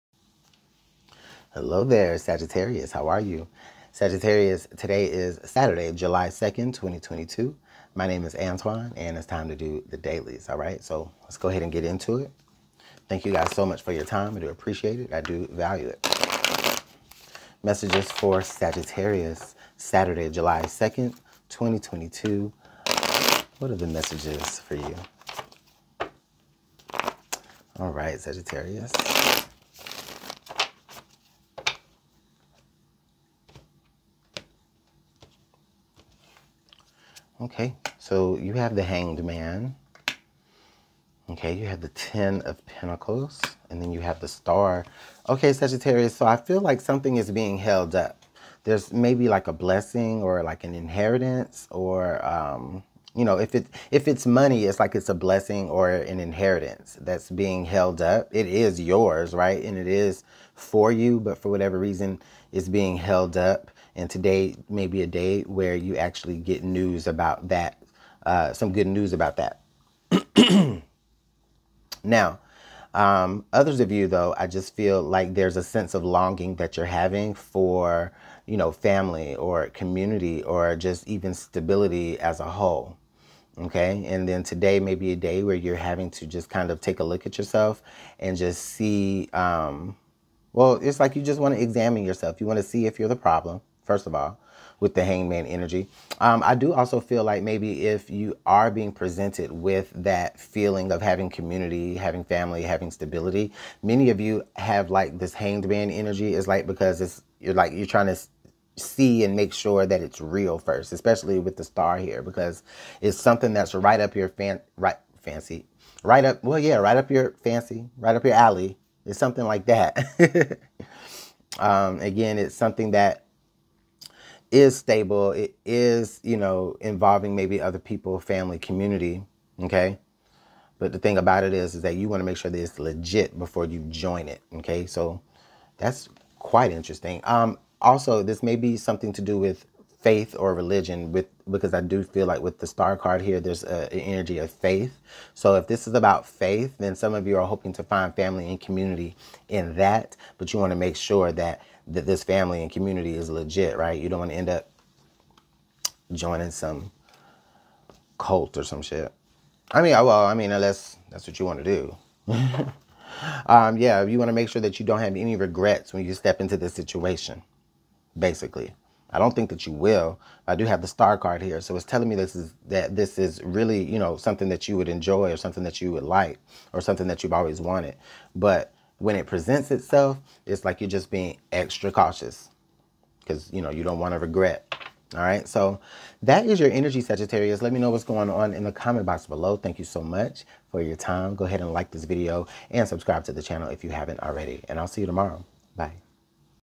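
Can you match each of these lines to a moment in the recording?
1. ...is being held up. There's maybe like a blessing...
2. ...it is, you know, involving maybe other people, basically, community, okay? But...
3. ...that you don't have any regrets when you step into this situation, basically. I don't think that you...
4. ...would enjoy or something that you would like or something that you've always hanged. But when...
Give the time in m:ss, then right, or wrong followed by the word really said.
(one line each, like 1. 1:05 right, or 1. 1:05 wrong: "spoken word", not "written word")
1. 0:47 right
2. 2:05 wrong: "family", not "basically"
3. 2:44 right
4. 2:54 wrong: "wanted", not "hanged".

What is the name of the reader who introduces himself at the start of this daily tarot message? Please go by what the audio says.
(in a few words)
Antwan.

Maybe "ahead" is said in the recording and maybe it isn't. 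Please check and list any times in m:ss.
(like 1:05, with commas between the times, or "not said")
0:11, 3:11.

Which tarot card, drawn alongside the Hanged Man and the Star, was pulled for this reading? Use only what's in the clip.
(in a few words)
Ten of Pentacles.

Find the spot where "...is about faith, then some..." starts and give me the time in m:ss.
2:25.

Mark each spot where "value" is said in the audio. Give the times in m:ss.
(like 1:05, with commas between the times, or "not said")
0:15.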